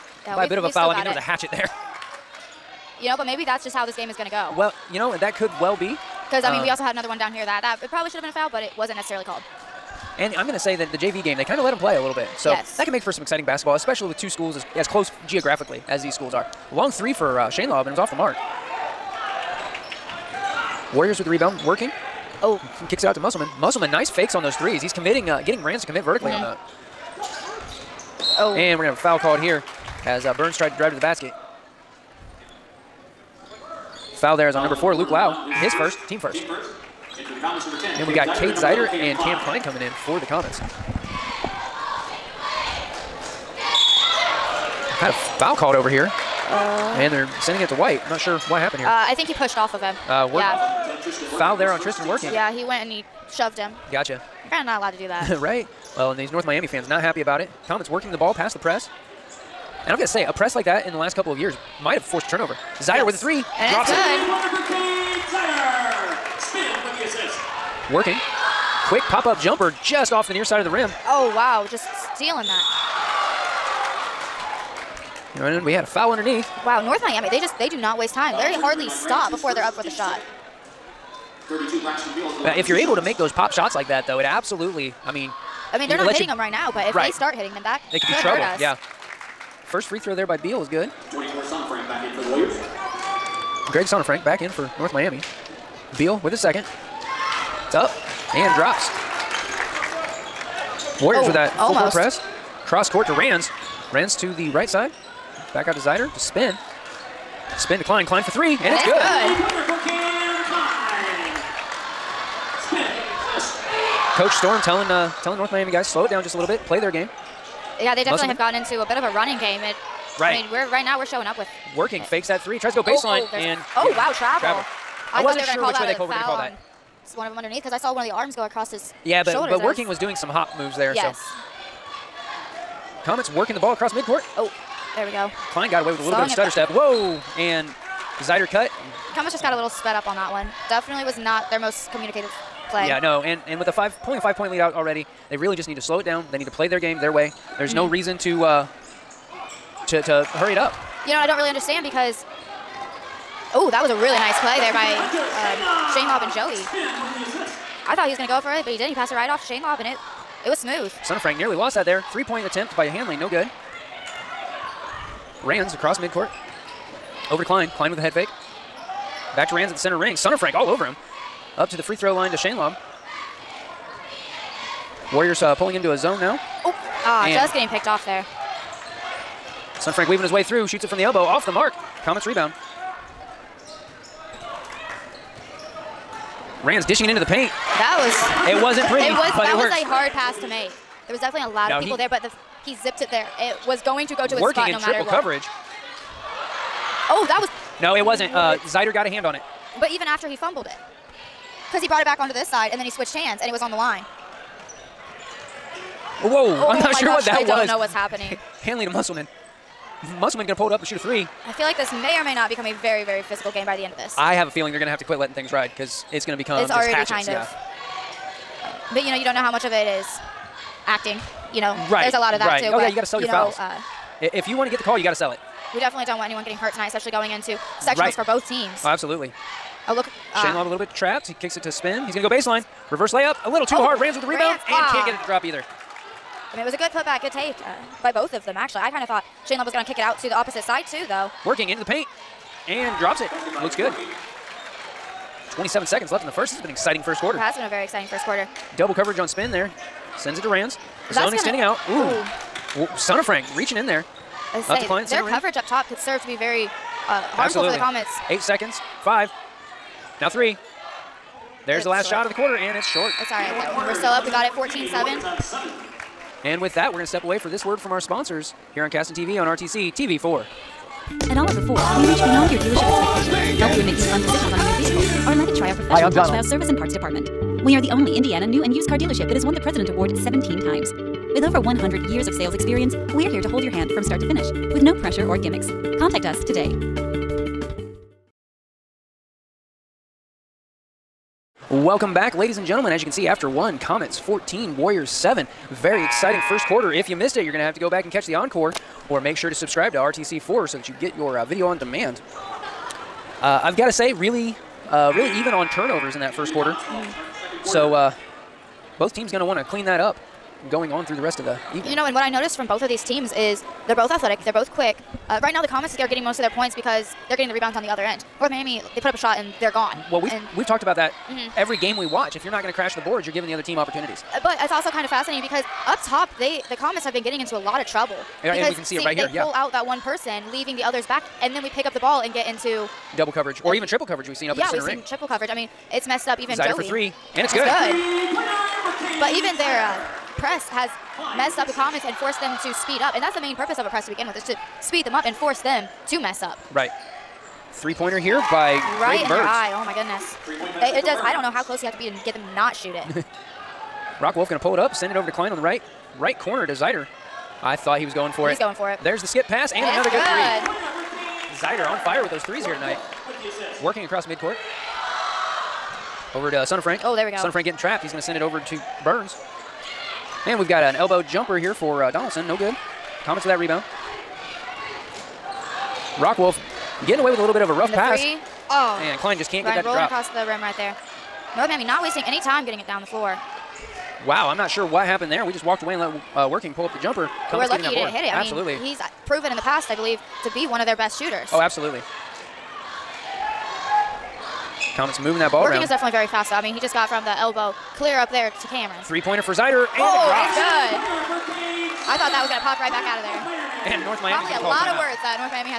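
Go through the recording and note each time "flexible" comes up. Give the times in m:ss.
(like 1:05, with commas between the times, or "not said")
not said.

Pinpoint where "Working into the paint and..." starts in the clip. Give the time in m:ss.
4:01.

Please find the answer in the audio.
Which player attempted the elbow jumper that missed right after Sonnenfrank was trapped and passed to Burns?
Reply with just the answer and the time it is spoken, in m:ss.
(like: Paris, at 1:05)
Donaldson, at 6:12.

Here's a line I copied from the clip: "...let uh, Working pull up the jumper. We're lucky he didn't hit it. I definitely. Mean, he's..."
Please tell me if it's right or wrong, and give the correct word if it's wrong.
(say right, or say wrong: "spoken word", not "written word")
wrong: "absolutely", not "definitely".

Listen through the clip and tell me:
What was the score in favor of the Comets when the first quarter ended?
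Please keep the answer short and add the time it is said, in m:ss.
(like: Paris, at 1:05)
14-7, at 4:24.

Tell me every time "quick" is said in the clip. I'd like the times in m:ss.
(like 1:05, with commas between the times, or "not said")
1:08, 5:14.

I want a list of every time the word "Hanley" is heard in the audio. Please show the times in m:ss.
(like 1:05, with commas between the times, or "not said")
2:42, 3:28.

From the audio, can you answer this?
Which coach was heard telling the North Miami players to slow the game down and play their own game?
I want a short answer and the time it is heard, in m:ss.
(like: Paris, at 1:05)
Coach Storm, at 1:54.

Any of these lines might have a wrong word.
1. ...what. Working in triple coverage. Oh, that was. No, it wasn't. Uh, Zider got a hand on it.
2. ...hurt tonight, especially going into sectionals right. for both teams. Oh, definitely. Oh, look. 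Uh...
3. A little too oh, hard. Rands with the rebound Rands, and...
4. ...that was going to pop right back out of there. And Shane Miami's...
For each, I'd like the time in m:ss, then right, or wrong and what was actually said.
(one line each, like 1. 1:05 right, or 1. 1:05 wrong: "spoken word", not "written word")
1. 3:14 right
2. 3:46 wrong: "absolutely", not "definitely"
3. 3:53 right
4. 6:42 wrong: "North", not "Shane".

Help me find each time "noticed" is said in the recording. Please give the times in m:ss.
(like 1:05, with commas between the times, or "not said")
5:12.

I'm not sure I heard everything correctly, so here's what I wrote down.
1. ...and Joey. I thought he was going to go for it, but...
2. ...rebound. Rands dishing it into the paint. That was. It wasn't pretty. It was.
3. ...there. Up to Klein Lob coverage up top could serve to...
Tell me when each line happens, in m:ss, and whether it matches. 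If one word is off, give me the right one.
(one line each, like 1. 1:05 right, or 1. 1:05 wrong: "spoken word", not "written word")
1. 2:36 right
2. 3:02 right
3. 4:13 wrong: "Their", not "Lob".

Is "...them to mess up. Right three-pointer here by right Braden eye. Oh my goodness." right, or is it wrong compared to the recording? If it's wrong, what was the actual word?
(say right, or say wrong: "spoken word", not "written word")
right.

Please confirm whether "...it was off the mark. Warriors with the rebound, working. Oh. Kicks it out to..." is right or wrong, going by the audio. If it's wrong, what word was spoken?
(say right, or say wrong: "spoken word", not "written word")
right.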